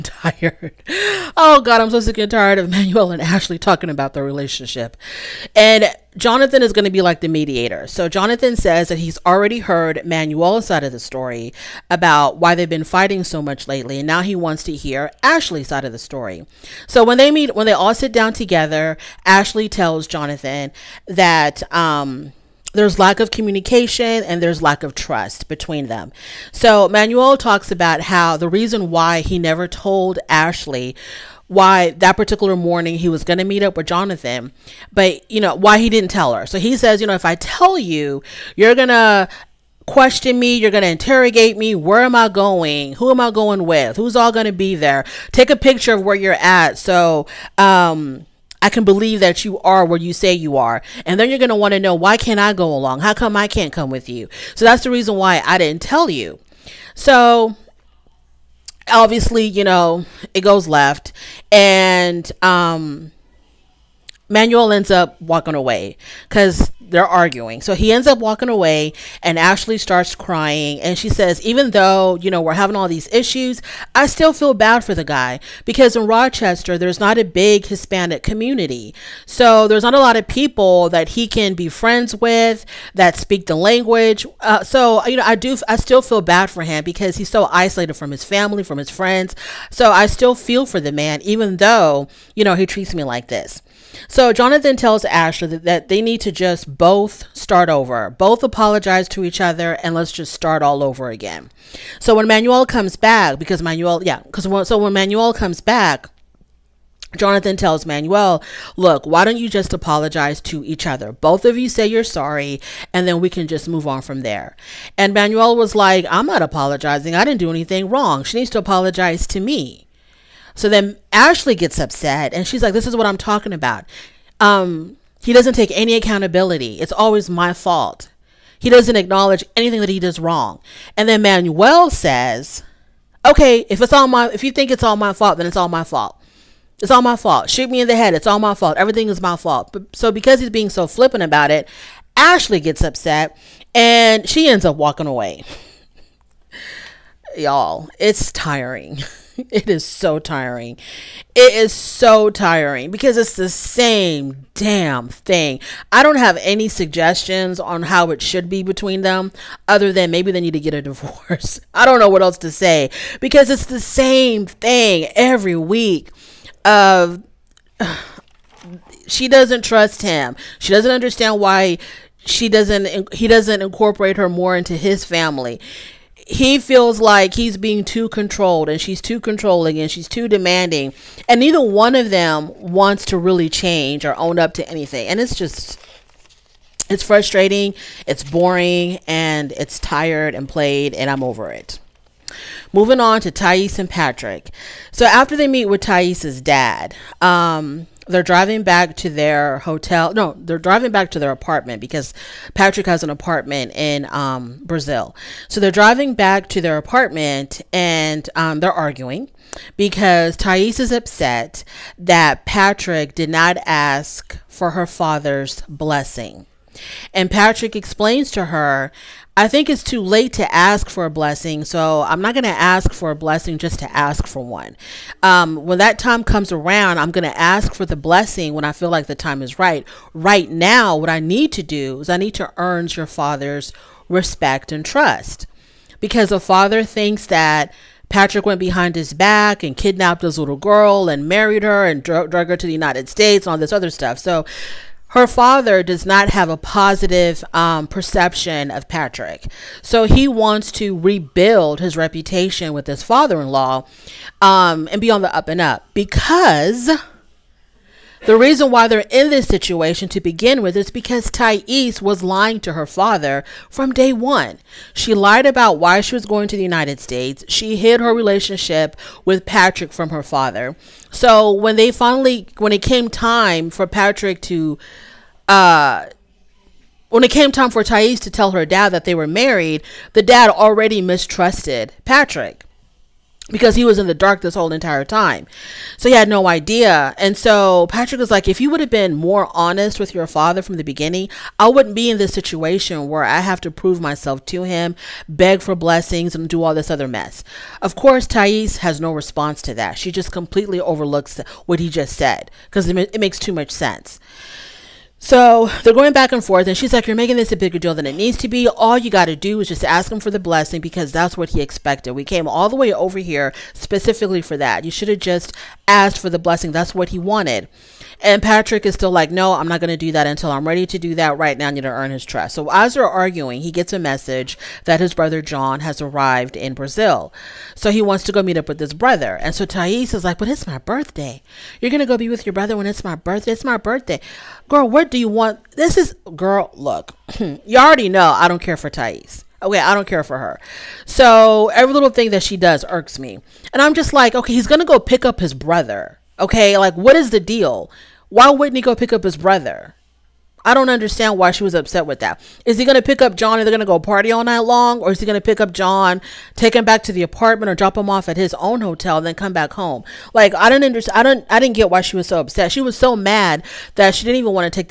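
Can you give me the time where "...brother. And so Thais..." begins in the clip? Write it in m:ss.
5:28.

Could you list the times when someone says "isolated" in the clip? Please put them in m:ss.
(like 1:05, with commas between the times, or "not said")
1:27.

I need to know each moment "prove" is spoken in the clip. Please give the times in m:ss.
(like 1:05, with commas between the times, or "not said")
4:53.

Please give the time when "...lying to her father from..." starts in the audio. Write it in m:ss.
4:22.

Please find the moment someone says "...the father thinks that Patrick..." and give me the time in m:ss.
3:56.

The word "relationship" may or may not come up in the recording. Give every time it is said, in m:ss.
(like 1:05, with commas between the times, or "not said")
0:04, 4:28.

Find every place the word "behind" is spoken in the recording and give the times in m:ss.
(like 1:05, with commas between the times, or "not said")
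3:58.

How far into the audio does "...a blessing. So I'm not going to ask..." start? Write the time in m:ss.
3:41.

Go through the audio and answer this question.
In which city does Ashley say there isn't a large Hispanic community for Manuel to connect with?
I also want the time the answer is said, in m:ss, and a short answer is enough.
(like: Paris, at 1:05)
Rochester, at 1:16.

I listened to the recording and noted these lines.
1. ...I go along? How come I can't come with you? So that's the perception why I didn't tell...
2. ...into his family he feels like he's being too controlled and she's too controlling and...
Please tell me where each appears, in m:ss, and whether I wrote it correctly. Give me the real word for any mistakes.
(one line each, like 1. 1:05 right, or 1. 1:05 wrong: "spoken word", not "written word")
1. 0:52 wrong: "reason", not "perception"
2. 2:54 right.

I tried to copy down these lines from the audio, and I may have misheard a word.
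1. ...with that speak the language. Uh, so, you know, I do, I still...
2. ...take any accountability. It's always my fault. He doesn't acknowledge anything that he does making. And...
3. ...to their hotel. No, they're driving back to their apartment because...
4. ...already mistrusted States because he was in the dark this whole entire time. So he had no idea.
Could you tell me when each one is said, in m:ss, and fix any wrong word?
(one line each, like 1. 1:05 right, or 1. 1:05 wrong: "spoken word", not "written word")
1. 1:22 right
2. 2:05 wrong: "wrong", not "making"
3. 3:18 right
4. 4:40 wrong: "Patrick", not "States".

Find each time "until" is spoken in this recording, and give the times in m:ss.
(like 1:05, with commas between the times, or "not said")
5:20.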